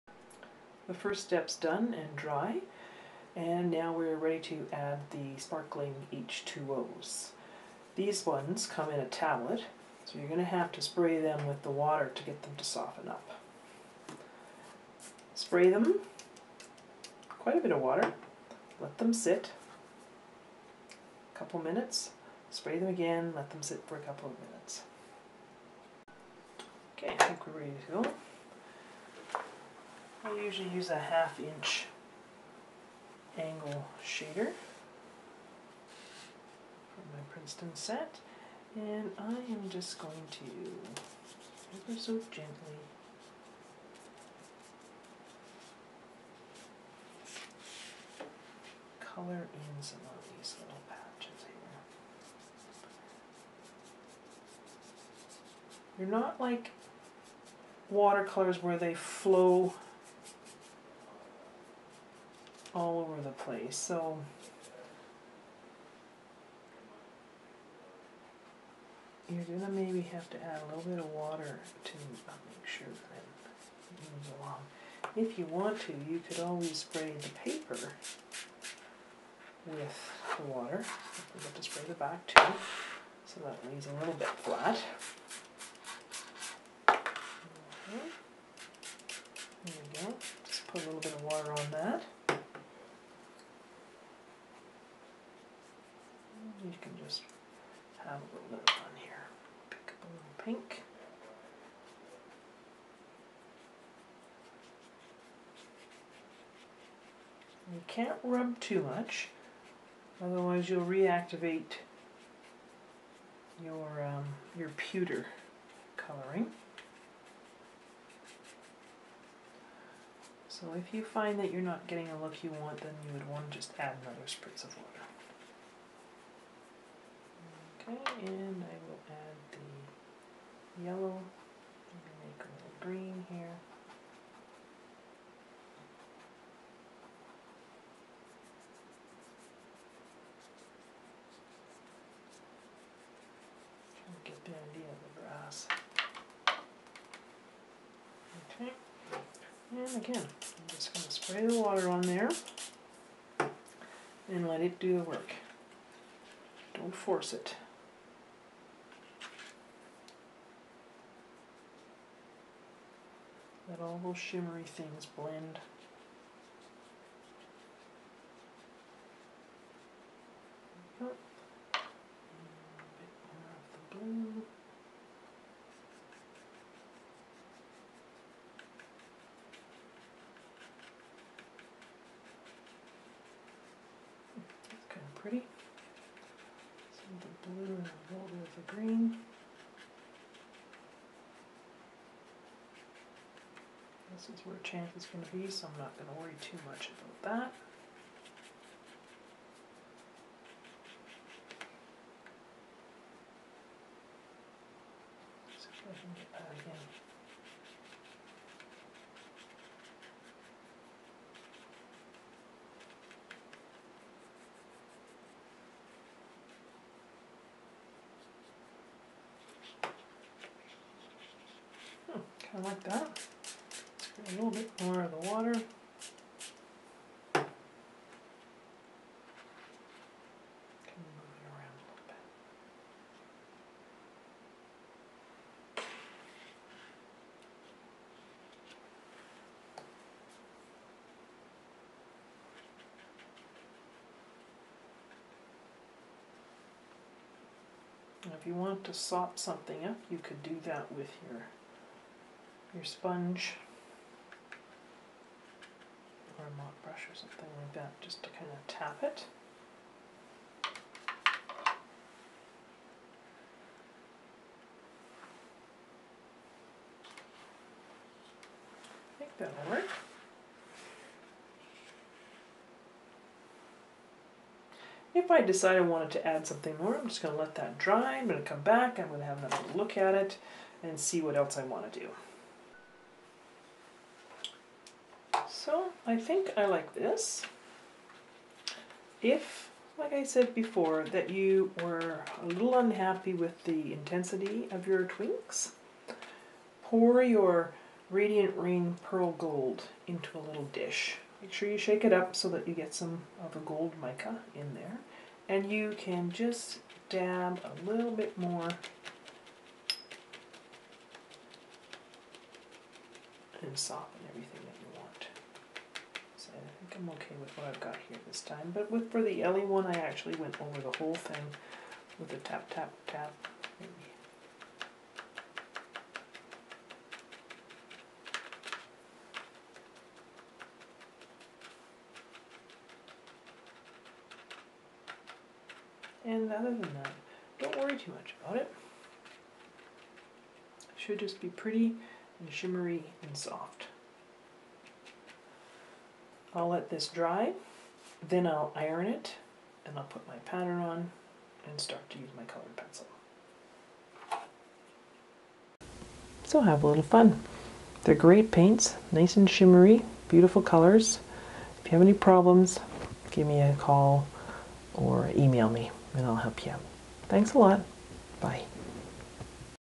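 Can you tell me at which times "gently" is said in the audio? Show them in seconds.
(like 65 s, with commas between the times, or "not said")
42 s.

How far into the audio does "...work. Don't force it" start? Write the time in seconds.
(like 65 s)
155 s.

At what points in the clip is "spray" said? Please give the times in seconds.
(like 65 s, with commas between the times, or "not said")
10 s, 15 s, 22 s, 76 s, 81 s, 151 s.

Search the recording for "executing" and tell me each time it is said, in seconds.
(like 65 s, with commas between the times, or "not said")
not said.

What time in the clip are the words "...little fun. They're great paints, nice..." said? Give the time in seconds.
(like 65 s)
356 s.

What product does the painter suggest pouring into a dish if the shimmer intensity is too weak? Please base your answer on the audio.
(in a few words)
Radiant Rain Pearl Gold.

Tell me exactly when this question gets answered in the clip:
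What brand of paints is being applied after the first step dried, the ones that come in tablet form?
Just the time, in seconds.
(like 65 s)
5 s.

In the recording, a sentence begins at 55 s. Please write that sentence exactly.
You're not like watercolors where they flow all over the place.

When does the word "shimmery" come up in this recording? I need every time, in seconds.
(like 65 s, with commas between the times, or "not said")
164 s, 342 s, 359 s.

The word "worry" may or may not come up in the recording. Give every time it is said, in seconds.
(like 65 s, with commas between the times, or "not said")
196 s, 337 s.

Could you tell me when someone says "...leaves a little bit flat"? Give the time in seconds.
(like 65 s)
83 s.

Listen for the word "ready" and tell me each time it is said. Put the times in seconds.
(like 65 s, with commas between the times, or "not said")
4 s, 27 s.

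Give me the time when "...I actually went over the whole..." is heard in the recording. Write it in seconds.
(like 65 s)
319 s.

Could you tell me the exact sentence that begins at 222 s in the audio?
Hmm, kind of like that a little bit more of the water.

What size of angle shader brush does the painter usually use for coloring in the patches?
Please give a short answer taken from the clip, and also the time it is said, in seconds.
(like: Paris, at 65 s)
Half inch, at 30 s.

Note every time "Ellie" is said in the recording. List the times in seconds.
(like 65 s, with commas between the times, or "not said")
319 s.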